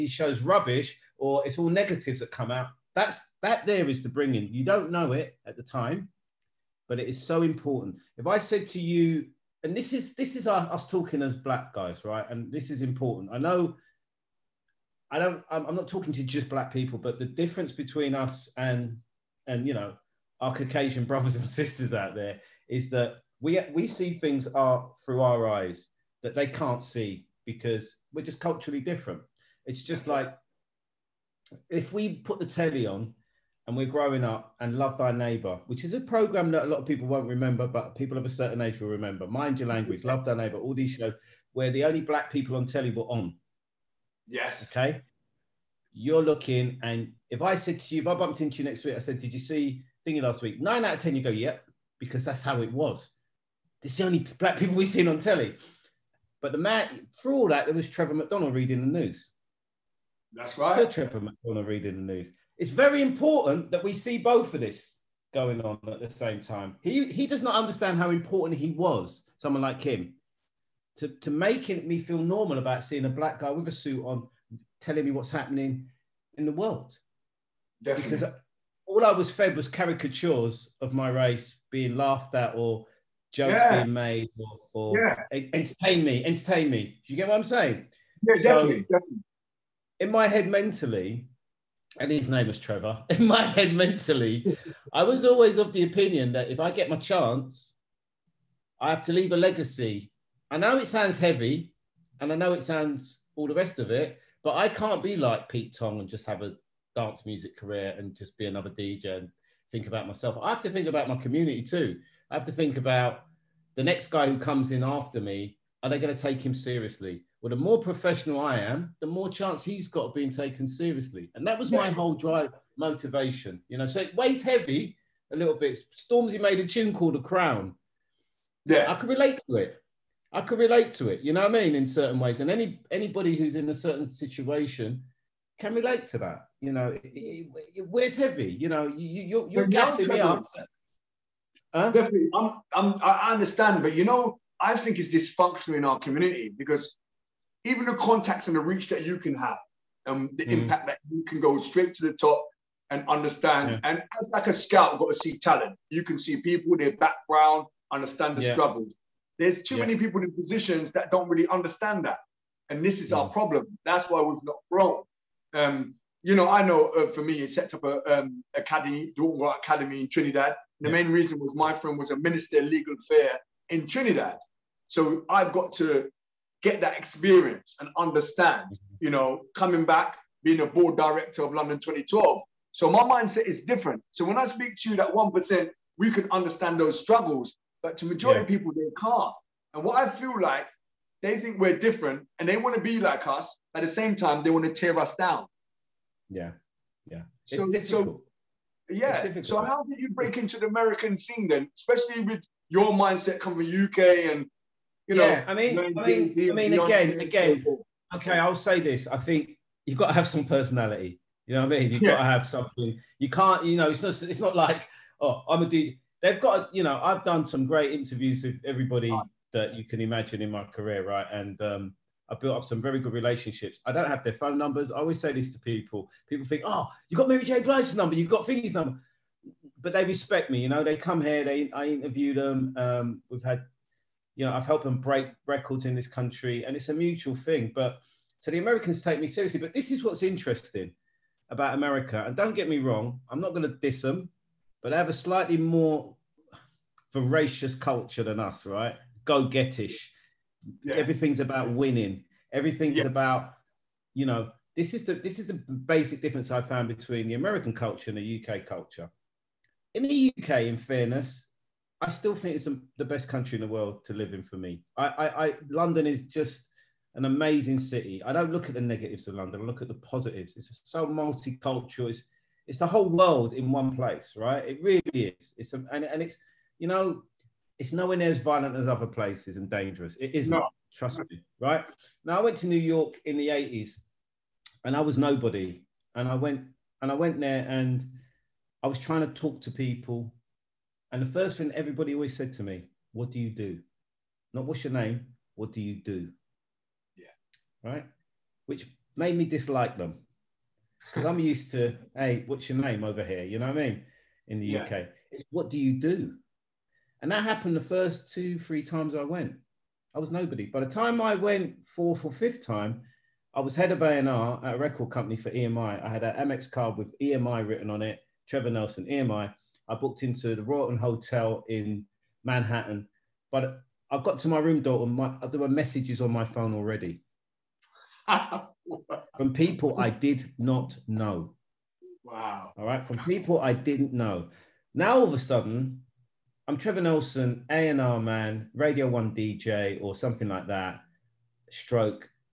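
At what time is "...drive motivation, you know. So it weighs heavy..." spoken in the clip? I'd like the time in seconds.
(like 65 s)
122 s.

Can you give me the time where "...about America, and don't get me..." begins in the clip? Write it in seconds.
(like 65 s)
241 s.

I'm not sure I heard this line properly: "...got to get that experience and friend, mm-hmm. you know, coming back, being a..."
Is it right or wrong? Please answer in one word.
wrong.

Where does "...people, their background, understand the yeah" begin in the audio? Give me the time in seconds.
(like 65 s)
156 s.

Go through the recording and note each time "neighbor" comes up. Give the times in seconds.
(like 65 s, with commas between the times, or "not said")
35 s, 40 s.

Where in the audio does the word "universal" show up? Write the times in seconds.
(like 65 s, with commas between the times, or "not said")
not said.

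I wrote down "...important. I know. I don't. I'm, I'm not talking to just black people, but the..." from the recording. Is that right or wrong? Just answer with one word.
right.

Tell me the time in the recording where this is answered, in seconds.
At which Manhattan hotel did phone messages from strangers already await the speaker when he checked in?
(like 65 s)
320 s.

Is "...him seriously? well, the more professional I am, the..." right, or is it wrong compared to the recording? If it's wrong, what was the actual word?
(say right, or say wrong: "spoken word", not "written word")
right.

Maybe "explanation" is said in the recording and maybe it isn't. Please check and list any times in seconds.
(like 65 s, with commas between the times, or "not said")
not said.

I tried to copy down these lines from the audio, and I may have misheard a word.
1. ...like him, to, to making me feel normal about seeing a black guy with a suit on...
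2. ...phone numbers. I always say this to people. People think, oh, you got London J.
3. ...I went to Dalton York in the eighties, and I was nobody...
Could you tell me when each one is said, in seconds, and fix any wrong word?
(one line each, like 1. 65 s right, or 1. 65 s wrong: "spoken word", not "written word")
1. 69 s right
2. 224 s wrong: "Mary", not "London"
3. 282 s wrong: "New", not "Dalton".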